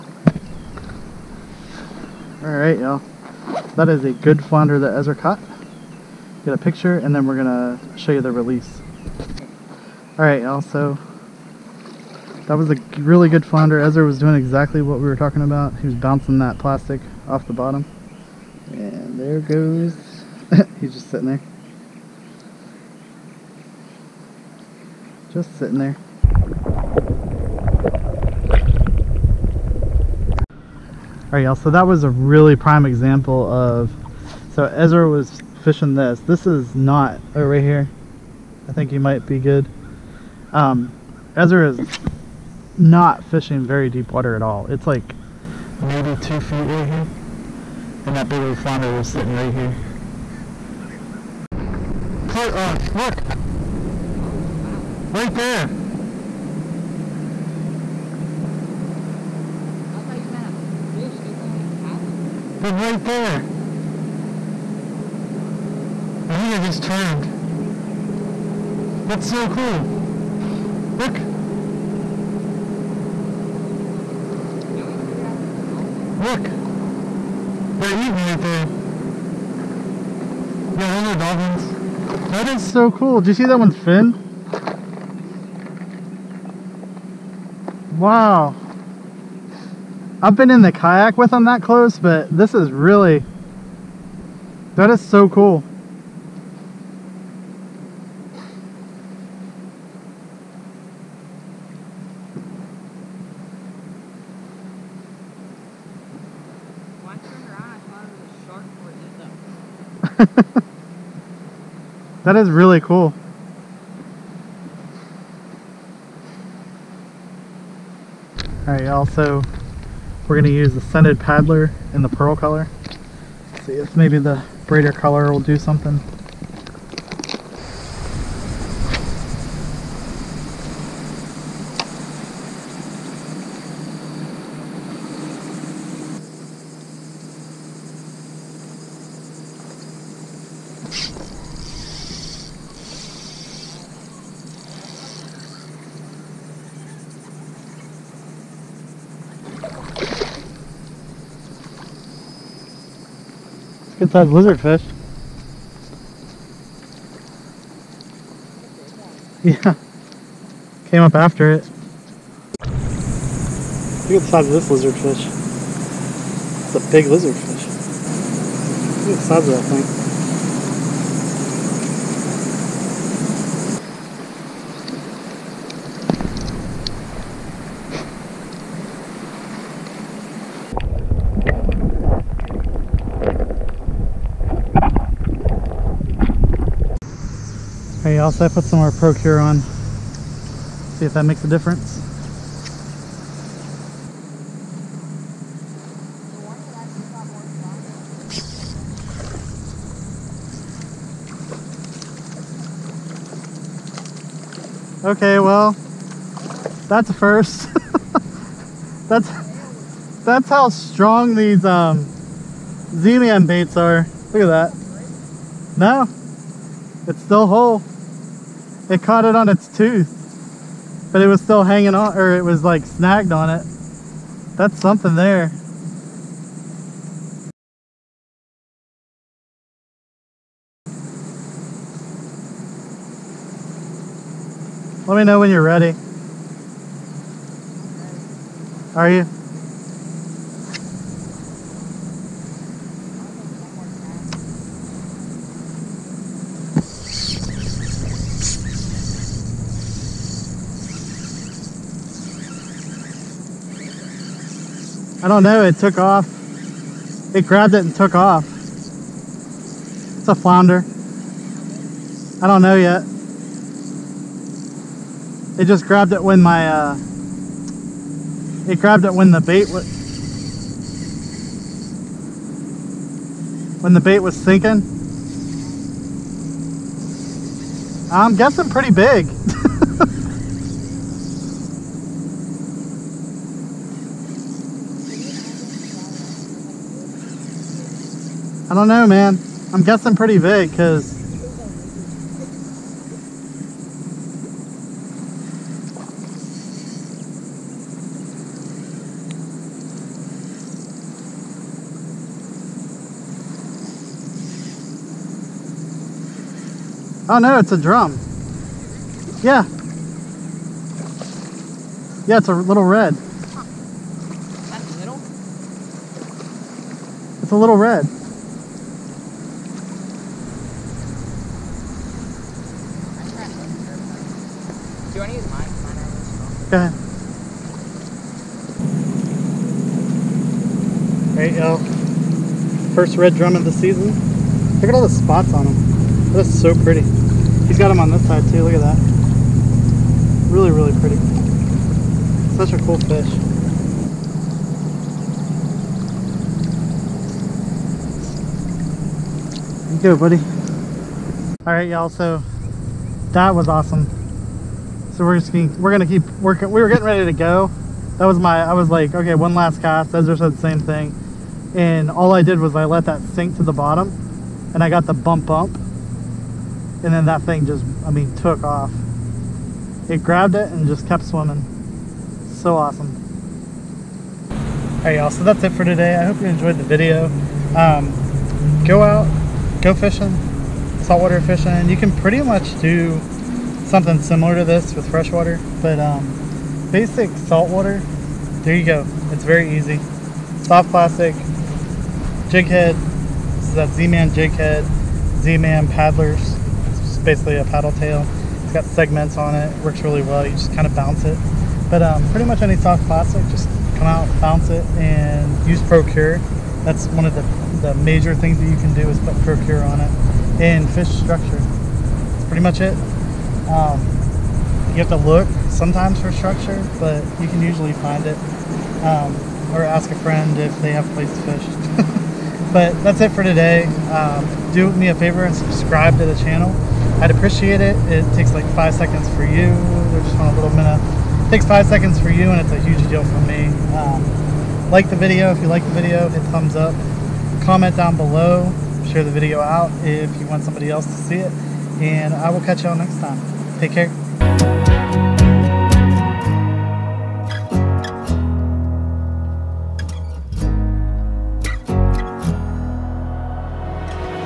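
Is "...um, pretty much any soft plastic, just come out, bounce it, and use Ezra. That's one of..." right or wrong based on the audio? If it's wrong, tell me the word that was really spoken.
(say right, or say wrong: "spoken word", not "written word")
wrong: "Procure", not "Ezra".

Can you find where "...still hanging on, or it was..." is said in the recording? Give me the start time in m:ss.
3:41.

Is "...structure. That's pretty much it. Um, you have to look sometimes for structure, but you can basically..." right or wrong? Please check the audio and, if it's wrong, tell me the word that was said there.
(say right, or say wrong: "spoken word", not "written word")
wrong: "usually", not "basically".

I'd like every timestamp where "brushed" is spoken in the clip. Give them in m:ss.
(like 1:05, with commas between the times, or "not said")
not said.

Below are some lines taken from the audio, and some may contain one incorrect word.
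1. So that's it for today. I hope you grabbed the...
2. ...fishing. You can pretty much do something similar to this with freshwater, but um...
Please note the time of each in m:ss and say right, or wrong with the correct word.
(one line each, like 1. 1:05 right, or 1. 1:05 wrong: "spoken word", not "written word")
1. 6:15 wrong: "enjoyed", not "grabbed"
2. 6:21 right.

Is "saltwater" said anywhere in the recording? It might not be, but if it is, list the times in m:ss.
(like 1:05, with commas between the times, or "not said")
6:21, 6:27.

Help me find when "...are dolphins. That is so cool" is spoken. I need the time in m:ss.
1:21.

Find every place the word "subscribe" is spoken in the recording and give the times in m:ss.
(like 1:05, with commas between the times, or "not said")
7:05.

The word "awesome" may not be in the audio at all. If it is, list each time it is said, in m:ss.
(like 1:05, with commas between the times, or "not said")
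5:53, 6:12.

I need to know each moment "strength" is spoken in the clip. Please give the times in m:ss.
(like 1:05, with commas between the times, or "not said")
not said.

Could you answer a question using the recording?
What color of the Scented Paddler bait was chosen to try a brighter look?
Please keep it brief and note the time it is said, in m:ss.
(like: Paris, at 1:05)
Pearl, at 2:02.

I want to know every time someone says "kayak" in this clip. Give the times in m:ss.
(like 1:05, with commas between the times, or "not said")
1:30.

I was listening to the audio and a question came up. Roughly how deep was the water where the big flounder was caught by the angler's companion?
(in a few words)
2 feet.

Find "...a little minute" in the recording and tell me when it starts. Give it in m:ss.
7:10.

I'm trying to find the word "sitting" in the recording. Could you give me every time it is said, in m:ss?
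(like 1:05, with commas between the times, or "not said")
0:21, 0:25, 0:49.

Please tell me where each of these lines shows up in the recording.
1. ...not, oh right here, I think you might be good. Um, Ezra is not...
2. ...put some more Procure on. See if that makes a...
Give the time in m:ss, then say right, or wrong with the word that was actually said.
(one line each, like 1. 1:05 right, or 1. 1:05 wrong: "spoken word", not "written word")
1. 0:36 right
2. 3:08 right.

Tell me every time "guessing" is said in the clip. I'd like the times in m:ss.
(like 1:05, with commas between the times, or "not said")
4:38, 4:49.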